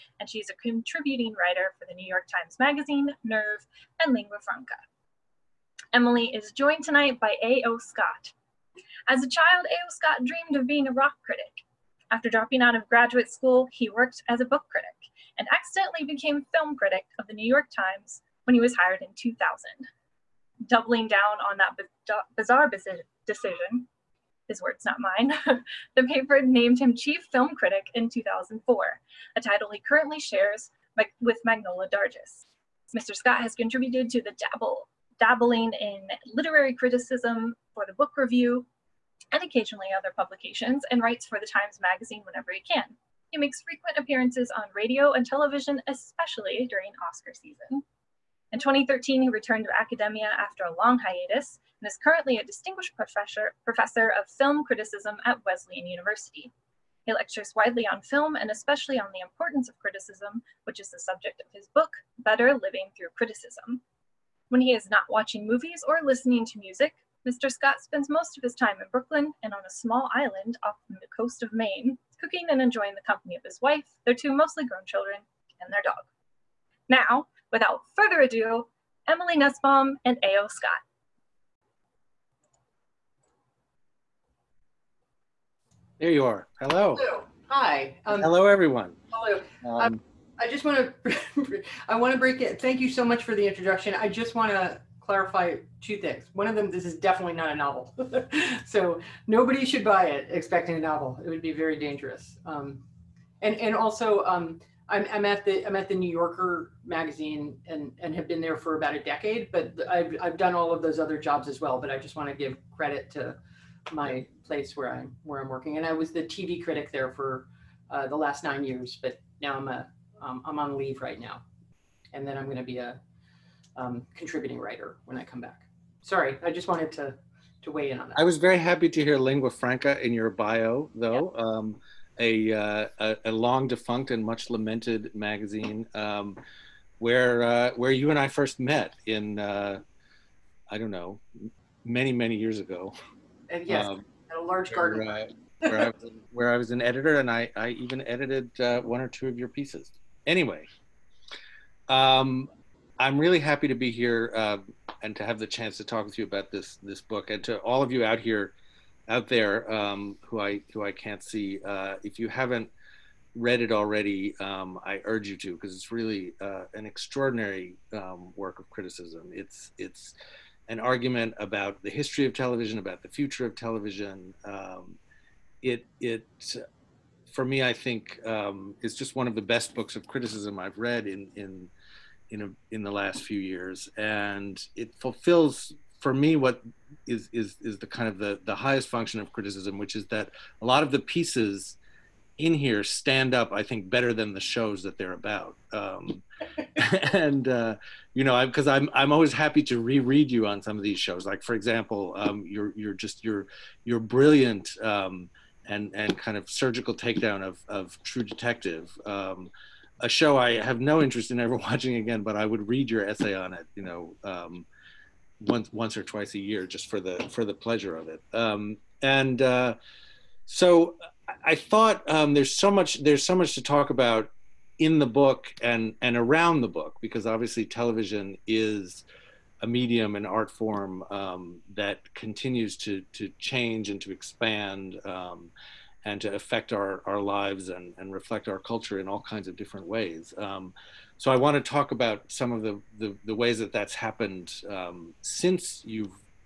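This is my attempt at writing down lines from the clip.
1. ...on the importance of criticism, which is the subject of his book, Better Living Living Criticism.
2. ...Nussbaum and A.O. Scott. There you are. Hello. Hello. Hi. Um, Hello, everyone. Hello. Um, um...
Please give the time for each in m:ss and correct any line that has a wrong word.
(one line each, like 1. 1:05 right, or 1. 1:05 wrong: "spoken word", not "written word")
1. 0:58 wrong: "Through", not "Living"
2. 1:19 right.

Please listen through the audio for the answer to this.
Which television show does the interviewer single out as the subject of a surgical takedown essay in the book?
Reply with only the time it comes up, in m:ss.
3:28.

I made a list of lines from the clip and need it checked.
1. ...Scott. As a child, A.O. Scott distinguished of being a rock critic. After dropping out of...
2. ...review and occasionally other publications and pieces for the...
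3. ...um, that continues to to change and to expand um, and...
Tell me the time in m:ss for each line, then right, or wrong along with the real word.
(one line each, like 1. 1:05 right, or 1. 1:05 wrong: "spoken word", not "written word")
1. 0:07 wrong: "dreamed", not "distinguished"
2. 0:38 wrong: "writes", not "pieces"
3. 3:51 right.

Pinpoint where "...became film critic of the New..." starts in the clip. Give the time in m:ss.
0:16.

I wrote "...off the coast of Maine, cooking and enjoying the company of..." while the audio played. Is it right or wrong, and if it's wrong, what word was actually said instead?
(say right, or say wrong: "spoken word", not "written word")
right.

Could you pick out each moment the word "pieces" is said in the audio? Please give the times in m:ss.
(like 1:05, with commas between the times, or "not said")
2:29, 3:10.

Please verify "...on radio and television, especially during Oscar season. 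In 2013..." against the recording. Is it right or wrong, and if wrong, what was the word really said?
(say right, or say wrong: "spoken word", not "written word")
right.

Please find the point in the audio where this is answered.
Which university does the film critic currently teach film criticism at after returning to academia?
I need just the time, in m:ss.
0:55.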